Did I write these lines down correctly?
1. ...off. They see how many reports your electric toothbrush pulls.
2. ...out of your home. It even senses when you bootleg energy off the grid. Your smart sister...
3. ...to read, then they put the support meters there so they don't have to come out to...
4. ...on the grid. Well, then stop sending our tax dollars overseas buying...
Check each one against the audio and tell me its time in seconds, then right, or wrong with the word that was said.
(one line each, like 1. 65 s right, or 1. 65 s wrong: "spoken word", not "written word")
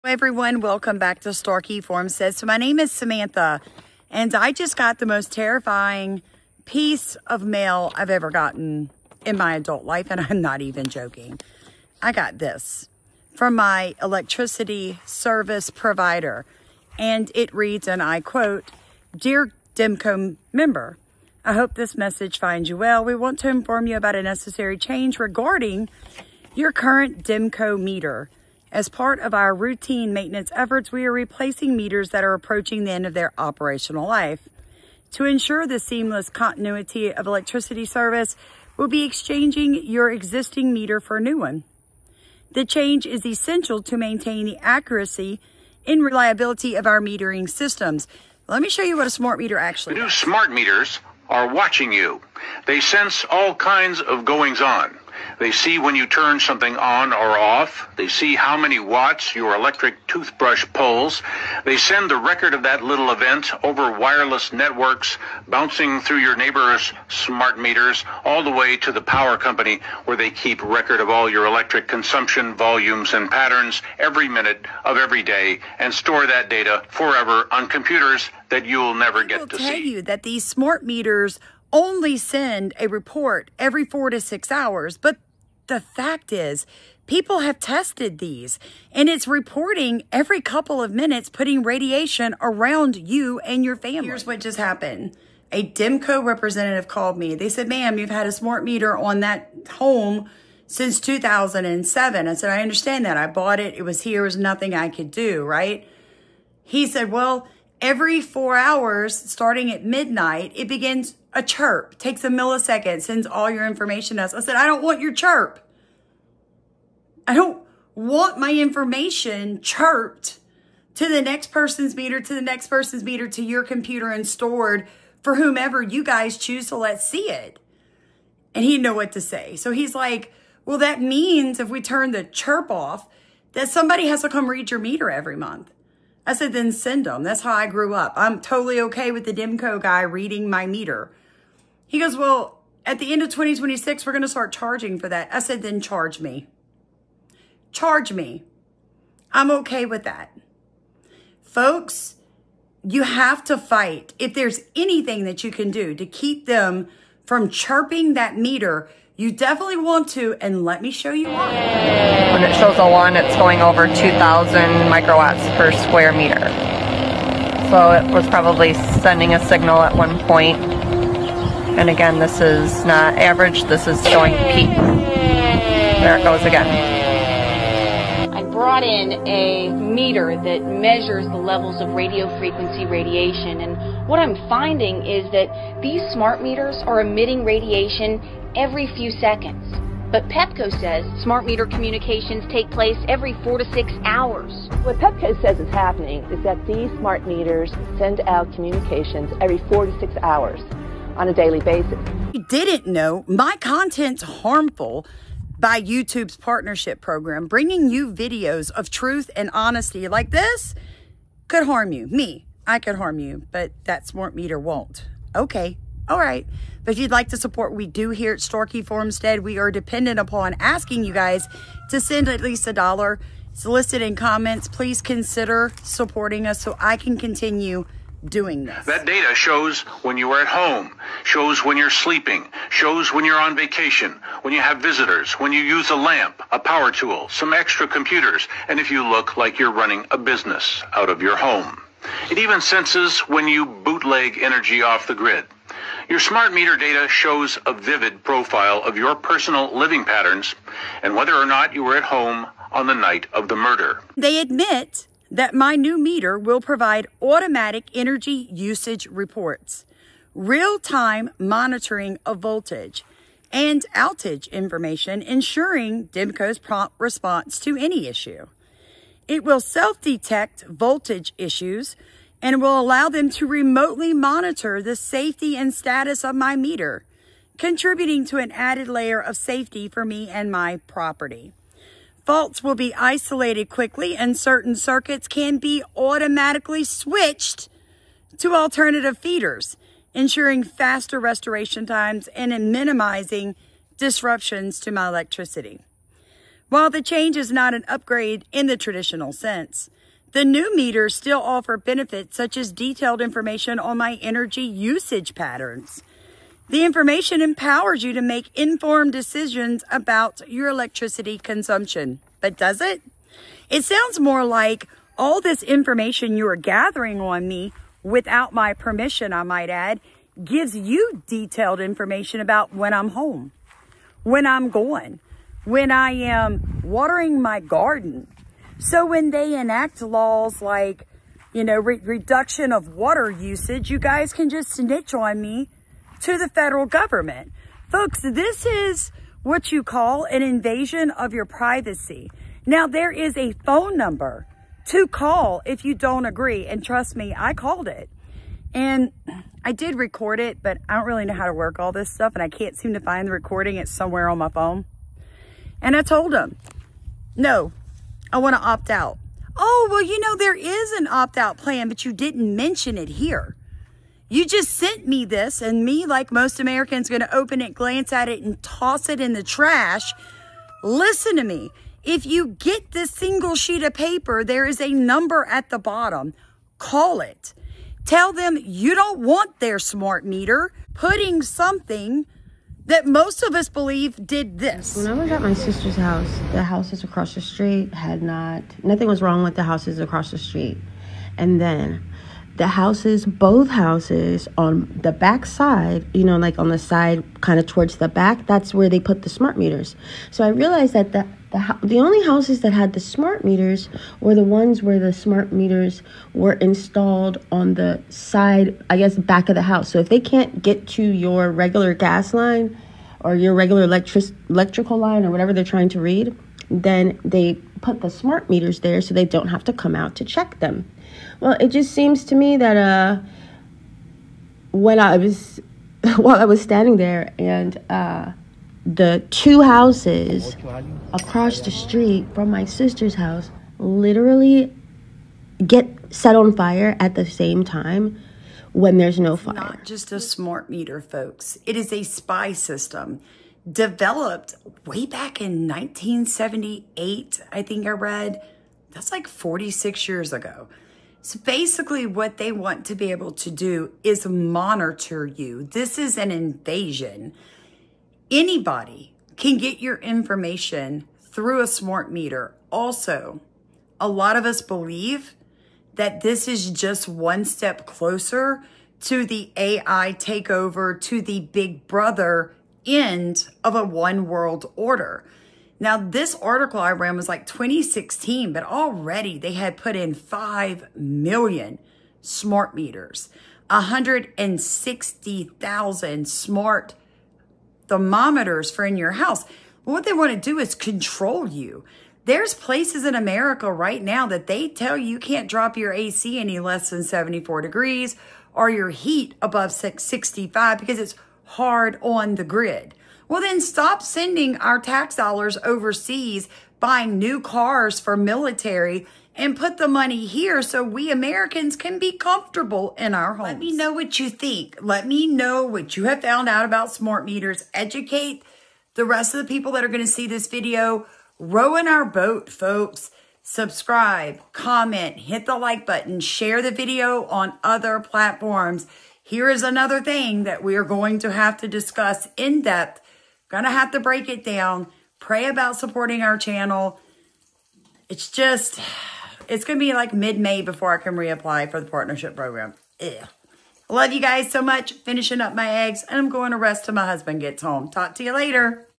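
1. 57 s wrong: "watts", not "reports"
2. 240 s wrong: "meter", not "sister"
3. 415 s wrong: "smart", not "support"
4. 502 s right.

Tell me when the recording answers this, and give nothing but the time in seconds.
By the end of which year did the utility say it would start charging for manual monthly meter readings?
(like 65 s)
143 s.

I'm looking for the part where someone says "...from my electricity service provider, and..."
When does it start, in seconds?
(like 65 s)
13 s.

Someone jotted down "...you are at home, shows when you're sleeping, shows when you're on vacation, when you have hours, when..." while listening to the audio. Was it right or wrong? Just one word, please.
wrong.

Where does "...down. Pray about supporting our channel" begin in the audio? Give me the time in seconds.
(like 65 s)
534 s.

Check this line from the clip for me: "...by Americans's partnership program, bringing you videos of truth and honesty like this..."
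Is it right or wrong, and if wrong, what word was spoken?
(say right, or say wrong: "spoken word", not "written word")
wrong: "YouTube", not "Americans".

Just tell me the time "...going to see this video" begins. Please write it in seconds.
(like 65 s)
519 s.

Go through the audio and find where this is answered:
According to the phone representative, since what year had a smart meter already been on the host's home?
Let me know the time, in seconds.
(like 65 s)
101 s.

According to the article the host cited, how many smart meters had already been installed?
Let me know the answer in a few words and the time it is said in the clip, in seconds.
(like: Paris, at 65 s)
5 million, at 480 s.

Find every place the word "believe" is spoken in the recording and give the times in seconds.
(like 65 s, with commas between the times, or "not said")
383 s, 464 s.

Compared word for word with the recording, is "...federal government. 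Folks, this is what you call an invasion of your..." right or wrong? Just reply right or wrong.
right.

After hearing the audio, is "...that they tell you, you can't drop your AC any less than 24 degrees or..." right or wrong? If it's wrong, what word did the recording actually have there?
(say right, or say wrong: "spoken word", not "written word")
wrong: "74", not "24".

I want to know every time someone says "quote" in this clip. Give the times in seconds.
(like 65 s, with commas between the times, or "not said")
18 s.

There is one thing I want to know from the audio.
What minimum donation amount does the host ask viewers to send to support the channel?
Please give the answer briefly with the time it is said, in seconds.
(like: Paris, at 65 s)
a dollar, at 222 s.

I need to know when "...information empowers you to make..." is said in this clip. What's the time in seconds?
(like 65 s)
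306 s.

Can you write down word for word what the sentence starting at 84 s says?
But the fact is, people have tested these and it's reporting every couple of minutes, putting radiation around you and your family.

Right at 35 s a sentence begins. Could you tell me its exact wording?
To ensure the seamless continuity of electricity service, we'll be exchanging your existing meter for a new one.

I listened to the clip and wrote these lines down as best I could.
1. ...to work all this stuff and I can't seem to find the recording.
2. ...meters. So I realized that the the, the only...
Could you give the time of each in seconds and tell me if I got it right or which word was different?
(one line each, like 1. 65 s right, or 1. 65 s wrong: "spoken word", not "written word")
1. 351 s right
2. 399 s right.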